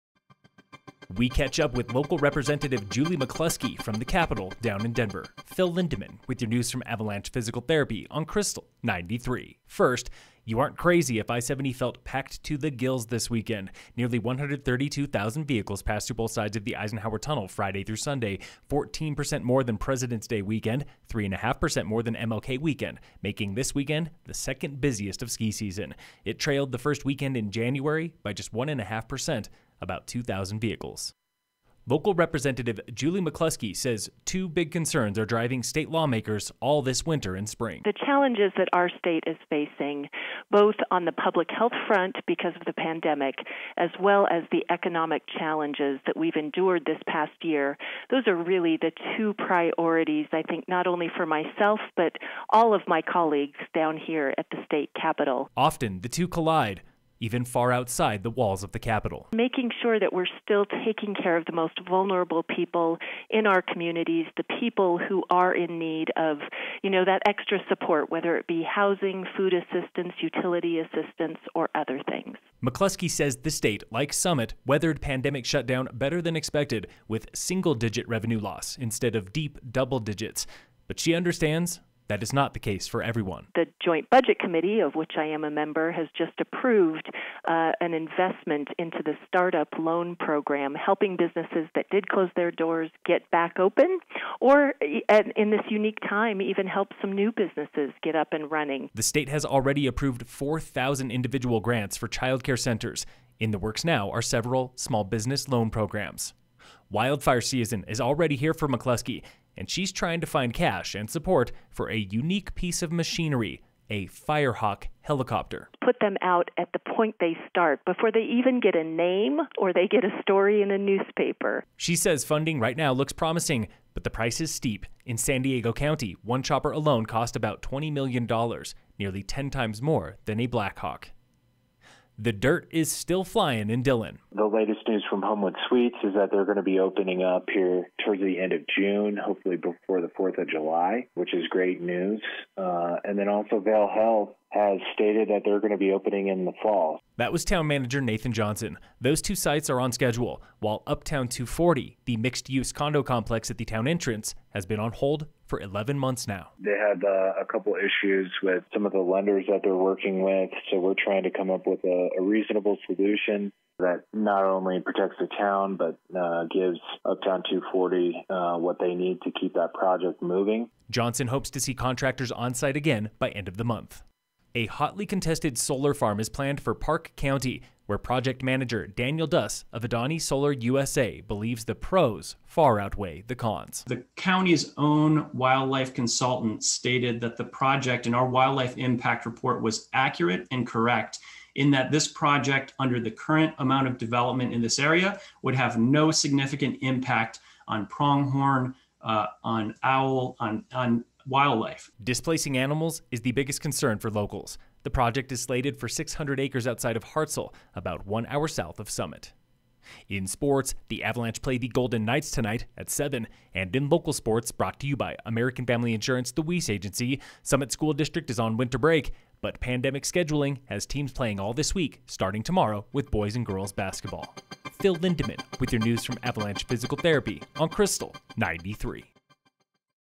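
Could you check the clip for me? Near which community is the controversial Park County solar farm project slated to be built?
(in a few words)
Hartsel.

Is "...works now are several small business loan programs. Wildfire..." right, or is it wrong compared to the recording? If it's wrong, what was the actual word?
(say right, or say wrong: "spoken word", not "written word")
right.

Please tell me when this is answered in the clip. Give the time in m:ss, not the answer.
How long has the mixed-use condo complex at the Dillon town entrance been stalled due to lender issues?
2:35.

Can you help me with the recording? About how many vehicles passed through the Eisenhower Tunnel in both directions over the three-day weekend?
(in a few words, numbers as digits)
132,000.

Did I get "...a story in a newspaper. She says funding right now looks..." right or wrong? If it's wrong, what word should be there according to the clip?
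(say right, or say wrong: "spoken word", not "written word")
right.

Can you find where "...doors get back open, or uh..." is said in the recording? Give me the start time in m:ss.
1:32.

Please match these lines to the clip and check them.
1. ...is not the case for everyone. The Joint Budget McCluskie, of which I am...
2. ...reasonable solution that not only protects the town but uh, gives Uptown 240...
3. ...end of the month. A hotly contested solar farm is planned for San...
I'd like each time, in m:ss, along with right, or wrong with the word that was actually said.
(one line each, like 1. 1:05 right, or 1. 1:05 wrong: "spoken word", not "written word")
1. 1:22 wrong: "Committee", not "McCluskie"
2. 2:42 right
3. 2:53 wrong: "Park", not "San".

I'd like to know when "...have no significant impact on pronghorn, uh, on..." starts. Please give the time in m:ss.
3:15.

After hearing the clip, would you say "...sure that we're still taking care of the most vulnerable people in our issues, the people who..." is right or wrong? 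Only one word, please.
wrong.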